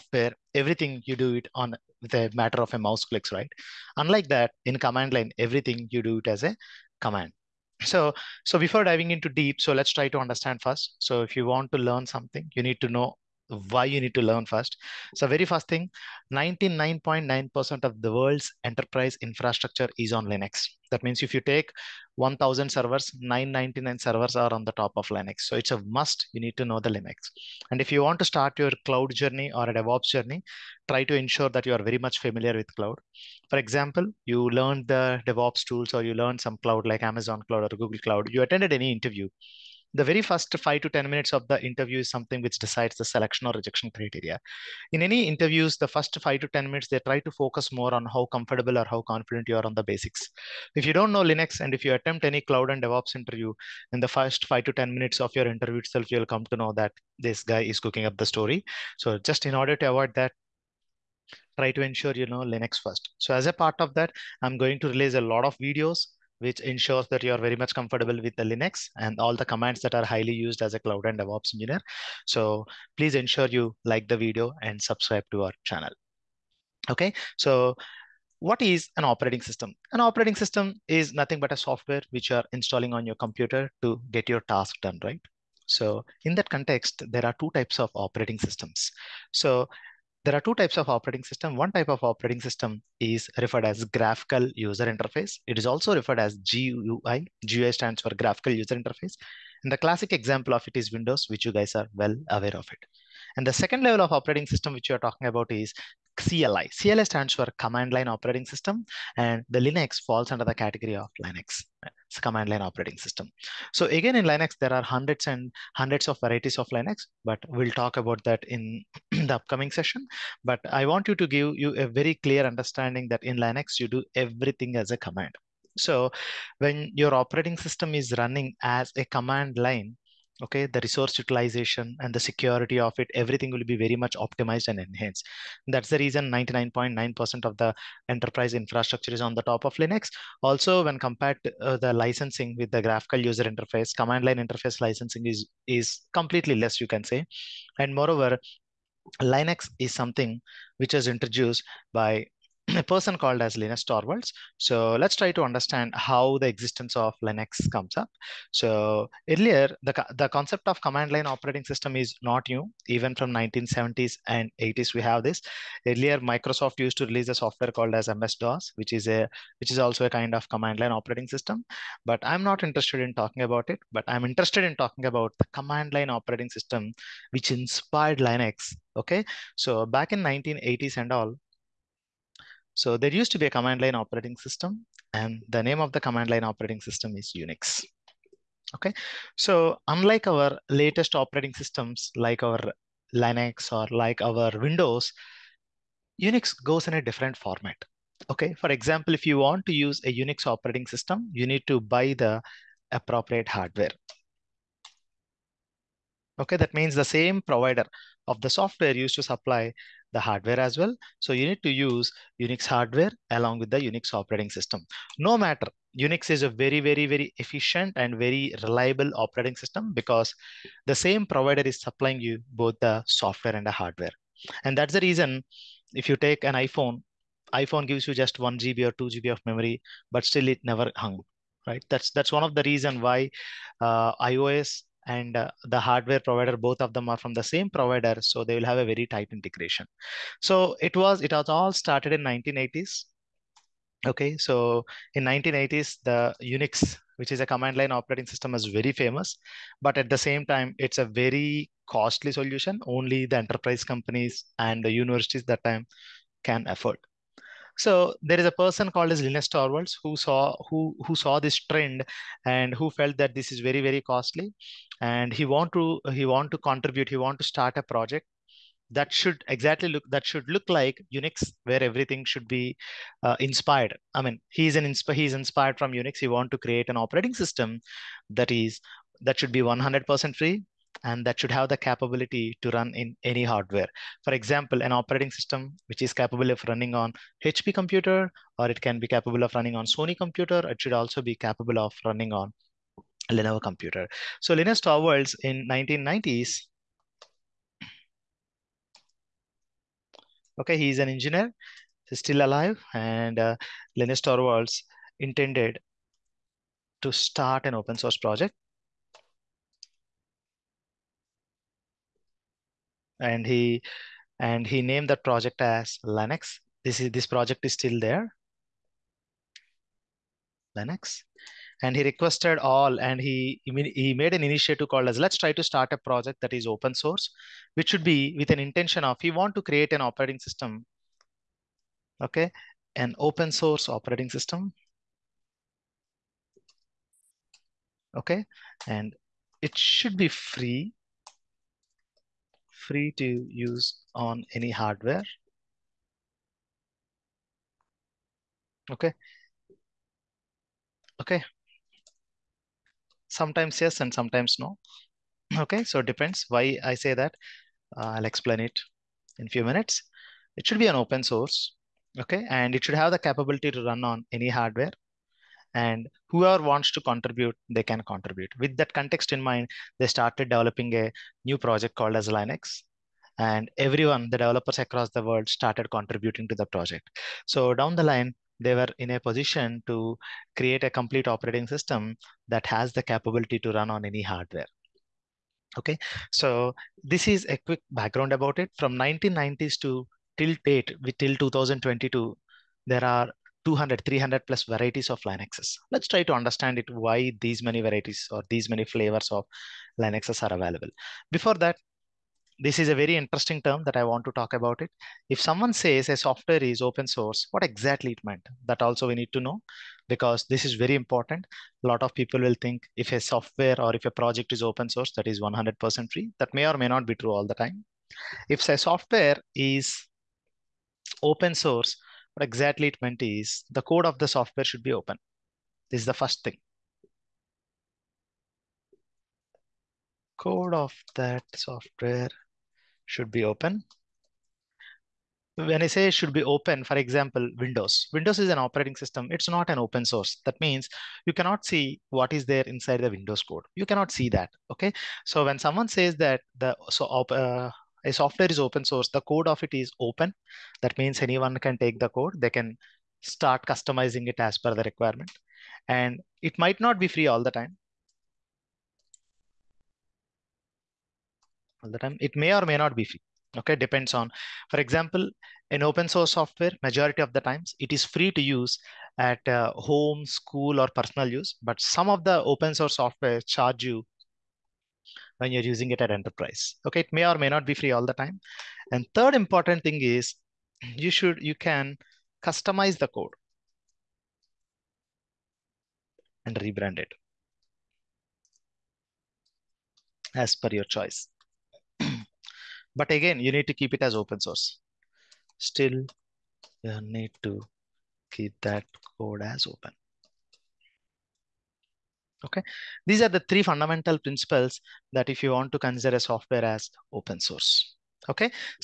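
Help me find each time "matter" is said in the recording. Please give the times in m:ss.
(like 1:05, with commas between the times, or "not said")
0:02, 3:35.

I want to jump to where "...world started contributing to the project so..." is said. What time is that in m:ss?
6:15.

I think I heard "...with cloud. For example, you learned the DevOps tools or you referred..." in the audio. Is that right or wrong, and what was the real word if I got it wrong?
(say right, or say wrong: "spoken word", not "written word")
wrong: "learned", not "referred".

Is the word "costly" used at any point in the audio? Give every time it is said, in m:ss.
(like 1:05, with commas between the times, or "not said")
4:11, 4:24.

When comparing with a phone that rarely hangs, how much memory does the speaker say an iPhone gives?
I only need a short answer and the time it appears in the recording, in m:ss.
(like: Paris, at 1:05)
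1 or 2 GB, at 3:48.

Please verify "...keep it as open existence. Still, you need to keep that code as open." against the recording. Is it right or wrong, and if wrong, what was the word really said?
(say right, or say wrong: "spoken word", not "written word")
wrong: "source", not "existence".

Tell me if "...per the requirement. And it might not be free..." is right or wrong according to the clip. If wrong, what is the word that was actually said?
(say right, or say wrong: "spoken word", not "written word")
right.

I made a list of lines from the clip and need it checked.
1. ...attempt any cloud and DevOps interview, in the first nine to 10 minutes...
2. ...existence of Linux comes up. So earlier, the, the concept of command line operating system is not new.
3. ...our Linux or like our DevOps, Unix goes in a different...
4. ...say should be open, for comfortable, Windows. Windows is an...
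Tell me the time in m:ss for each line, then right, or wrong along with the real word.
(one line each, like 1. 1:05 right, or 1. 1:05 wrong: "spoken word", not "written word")
1. 0:51 wrong: "five", not "nine"
2. 2:36 right
3. 3:12 wrong: "Windows", not "DevOps"
4. 7:15 wrong: "example", not "comfortable".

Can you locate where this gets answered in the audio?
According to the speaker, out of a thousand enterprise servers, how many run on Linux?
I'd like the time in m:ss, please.
0:23.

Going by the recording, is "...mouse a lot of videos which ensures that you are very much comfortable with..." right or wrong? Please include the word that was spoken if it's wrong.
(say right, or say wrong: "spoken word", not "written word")
wrong: "release", not "mouse".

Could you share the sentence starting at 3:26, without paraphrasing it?
Okay, that means the same provider of the software used to supply the hardware as well.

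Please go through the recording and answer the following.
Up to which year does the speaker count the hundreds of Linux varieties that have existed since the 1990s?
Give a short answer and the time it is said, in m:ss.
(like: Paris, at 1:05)
2022, at 6:31.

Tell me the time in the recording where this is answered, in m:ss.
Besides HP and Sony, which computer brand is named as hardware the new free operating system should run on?
4:53.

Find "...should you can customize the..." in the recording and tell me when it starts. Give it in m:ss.
8:01.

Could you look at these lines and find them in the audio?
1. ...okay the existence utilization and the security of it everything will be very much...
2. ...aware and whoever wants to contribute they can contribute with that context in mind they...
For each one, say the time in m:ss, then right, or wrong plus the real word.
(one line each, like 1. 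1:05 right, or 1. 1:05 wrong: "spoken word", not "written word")
1. 2:10 wrong: "resource", not "existence"
2. 6:04 wrong: "hardware", not "aware".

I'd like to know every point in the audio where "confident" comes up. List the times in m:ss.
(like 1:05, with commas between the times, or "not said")
0:49.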